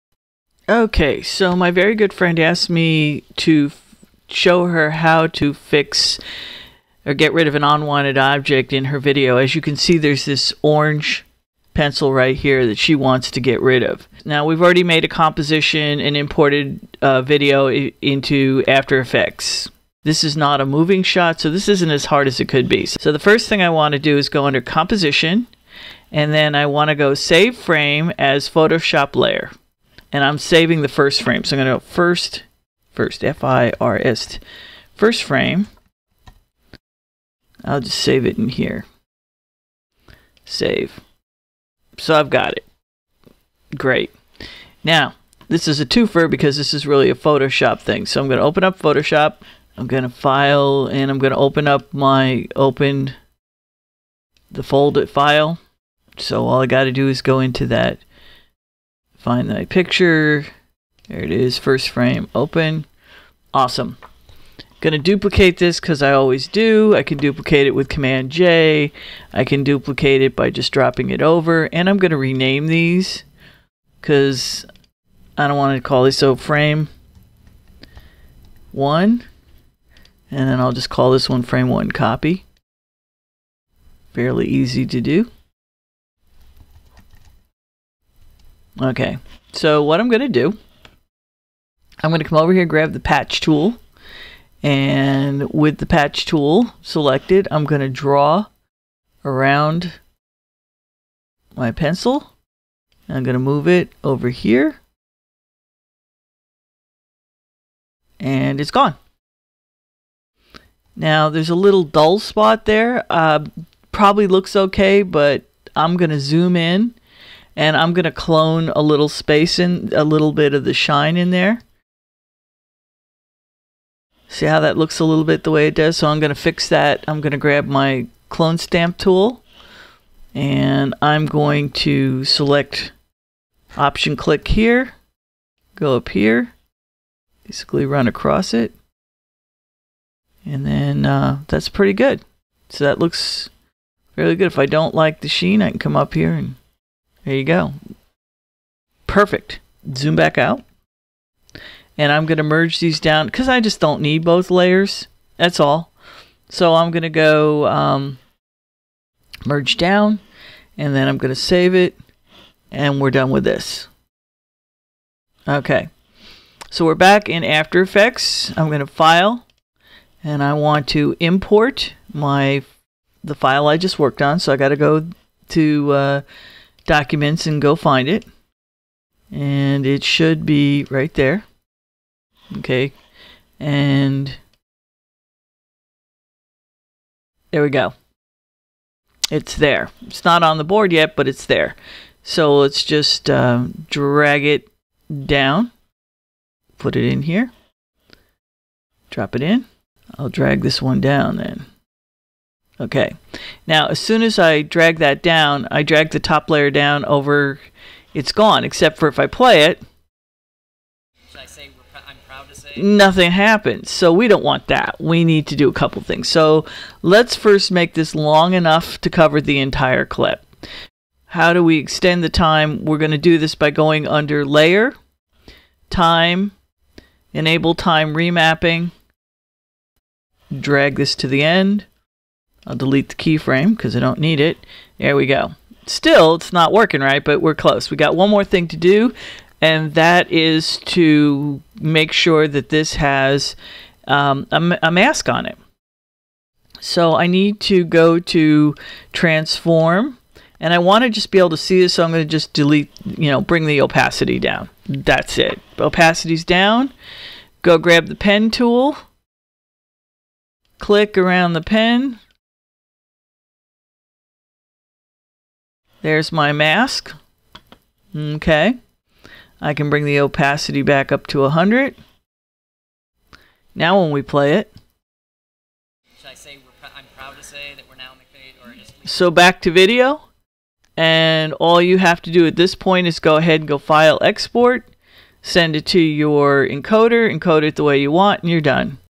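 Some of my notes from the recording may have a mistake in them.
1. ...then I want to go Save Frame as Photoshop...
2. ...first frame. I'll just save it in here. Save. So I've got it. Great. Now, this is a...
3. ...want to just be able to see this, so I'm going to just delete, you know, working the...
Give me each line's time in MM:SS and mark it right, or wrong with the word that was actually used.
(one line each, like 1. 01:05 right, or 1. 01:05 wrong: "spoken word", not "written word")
1. 00:26 right
2. 00:34 right
3. 04:10 wrong: "bring", not "working".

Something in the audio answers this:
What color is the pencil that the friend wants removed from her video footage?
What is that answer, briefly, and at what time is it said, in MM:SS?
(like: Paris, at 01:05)
Orange, at 00:10.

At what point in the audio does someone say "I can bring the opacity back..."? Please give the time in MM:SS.
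04:29.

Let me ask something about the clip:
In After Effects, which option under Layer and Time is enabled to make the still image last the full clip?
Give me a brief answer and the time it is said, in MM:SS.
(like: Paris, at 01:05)
Enable Time Remapping, at 03:47.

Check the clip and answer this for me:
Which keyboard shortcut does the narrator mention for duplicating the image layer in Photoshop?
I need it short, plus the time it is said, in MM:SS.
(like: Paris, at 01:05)
Command J, at 01:07.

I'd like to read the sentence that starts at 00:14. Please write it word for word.
Now we've already made a composition and imported uh, video into After Effects.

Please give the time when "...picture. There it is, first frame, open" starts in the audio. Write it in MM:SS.
00:59.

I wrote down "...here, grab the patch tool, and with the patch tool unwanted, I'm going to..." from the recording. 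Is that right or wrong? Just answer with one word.
wrong.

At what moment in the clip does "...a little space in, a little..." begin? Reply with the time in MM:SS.
01:58.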